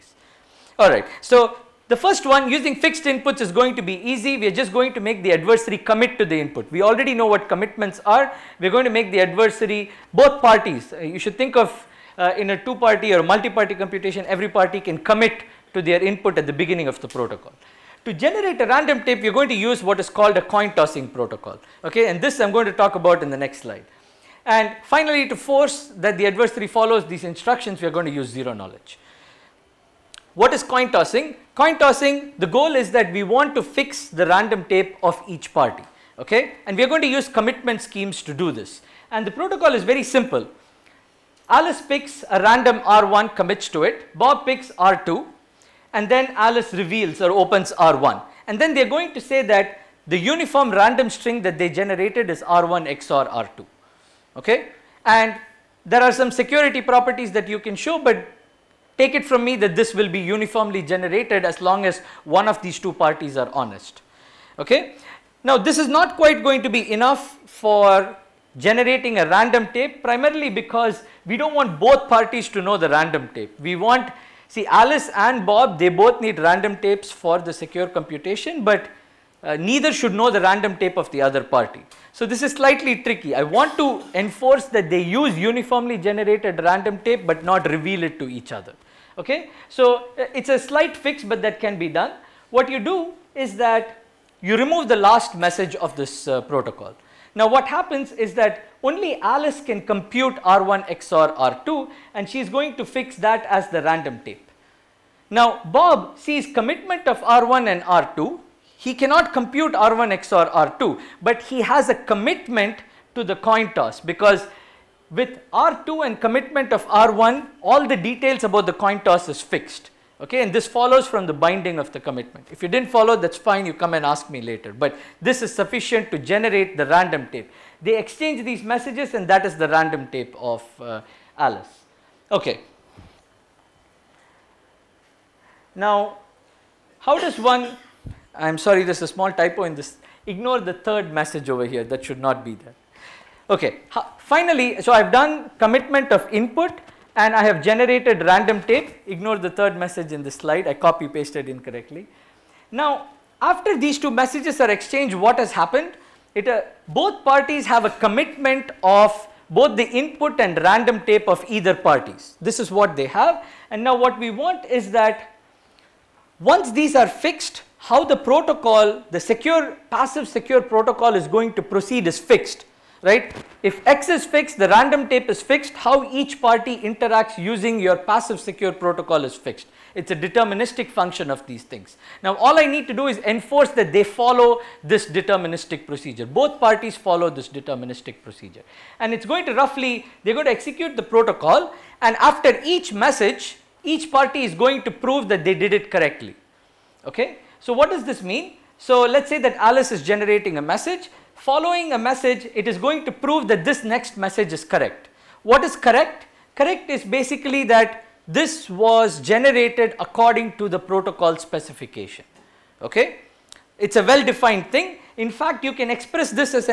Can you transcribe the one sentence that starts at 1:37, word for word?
Now what happens is that only Alice can compute R1 XOR R2 and she's going to fix that as the random tape.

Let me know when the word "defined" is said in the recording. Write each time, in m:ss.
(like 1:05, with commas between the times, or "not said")
3:34.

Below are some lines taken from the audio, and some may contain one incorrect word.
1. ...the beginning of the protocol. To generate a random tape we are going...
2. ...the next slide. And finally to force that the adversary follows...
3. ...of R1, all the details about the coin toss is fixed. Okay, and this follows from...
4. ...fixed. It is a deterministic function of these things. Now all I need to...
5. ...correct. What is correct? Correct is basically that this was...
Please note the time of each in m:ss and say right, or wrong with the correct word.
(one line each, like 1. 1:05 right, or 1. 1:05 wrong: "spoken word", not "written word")
1. 0:16 right
2. 0:23 right
3. 1:56 right
4. 2:59 right
5. 3:24 right.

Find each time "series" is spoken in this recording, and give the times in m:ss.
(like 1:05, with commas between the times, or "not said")
not said.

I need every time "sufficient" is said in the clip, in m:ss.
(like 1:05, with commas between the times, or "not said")
2:05.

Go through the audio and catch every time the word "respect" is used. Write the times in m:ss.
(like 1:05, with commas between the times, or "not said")
not said.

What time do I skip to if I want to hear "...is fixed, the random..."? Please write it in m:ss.
2:54.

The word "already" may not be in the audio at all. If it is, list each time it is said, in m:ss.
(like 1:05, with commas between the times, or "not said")
0:06.